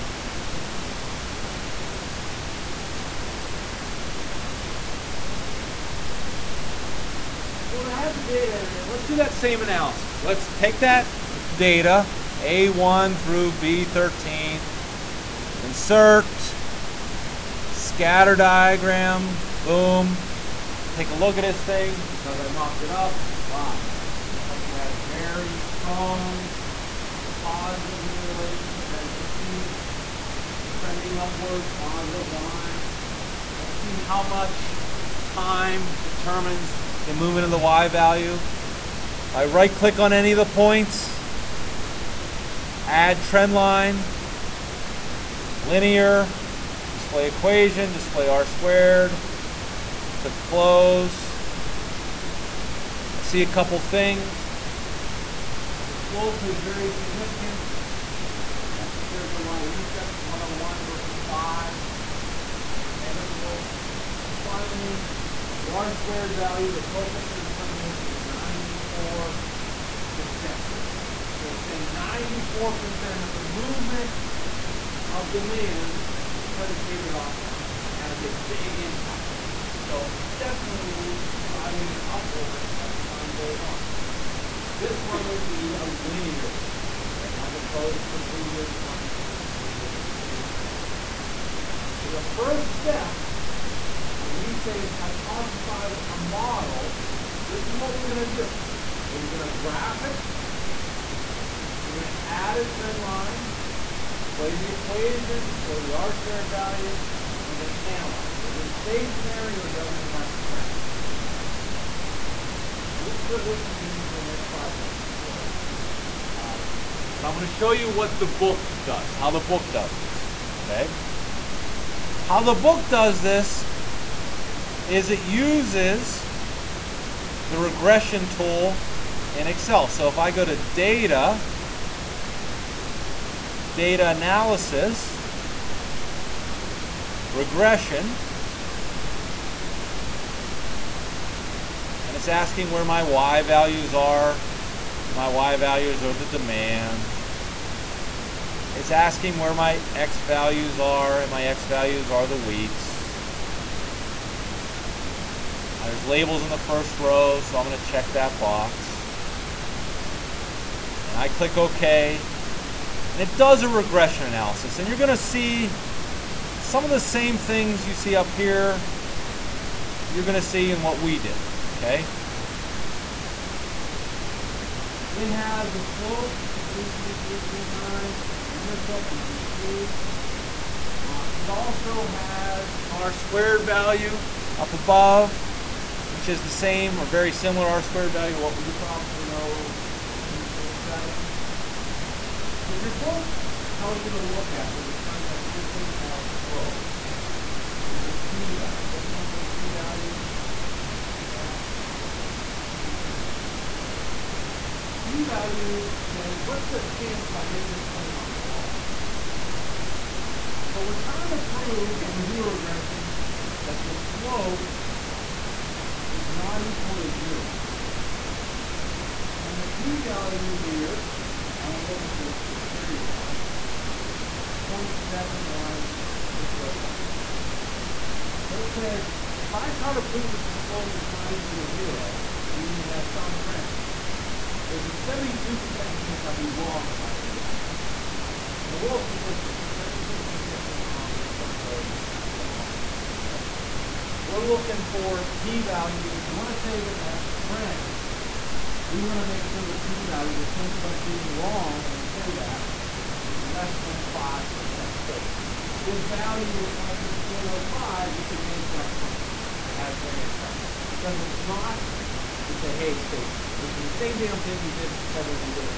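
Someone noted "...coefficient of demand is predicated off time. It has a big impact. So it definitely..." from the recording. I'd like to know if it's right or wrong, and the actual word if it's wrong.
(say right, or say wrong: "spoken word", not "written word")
wrong: "movement", not "coefficient".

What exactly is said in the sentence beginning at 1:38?
Okay, we're going to graph it.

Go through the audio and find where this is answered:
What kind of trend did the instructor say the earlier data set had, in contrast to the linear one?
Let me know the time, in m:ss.
1:30.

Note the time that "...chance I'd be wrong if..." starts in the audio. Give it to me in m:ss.
3:56.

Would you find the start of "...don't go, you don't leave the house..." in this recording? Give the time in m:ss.
4:01.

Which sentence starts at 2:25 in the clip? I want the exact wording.
And my Y values are the demand.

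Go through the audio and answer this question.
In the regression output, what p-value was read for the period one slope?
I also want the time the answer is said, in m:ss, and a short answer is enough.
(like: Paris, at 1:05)
0.71601, at 3:44.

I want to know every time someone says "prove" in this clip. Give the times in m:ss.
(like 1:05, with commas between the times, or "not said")
3:31, 3:50.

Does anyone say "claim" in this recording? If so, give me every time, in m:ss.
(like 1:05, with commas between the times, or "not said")
3:27, 3:57, 4:18.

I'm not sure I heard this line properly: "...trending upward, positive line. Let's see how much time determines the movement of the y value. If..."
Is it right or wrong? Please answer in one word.
right.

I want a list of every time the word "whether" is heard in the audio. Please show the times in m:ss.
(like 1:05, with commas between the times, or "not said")
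not said.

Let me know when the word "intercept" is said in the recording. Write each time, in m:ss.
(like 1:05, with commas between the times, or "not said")
0:59, 2:58.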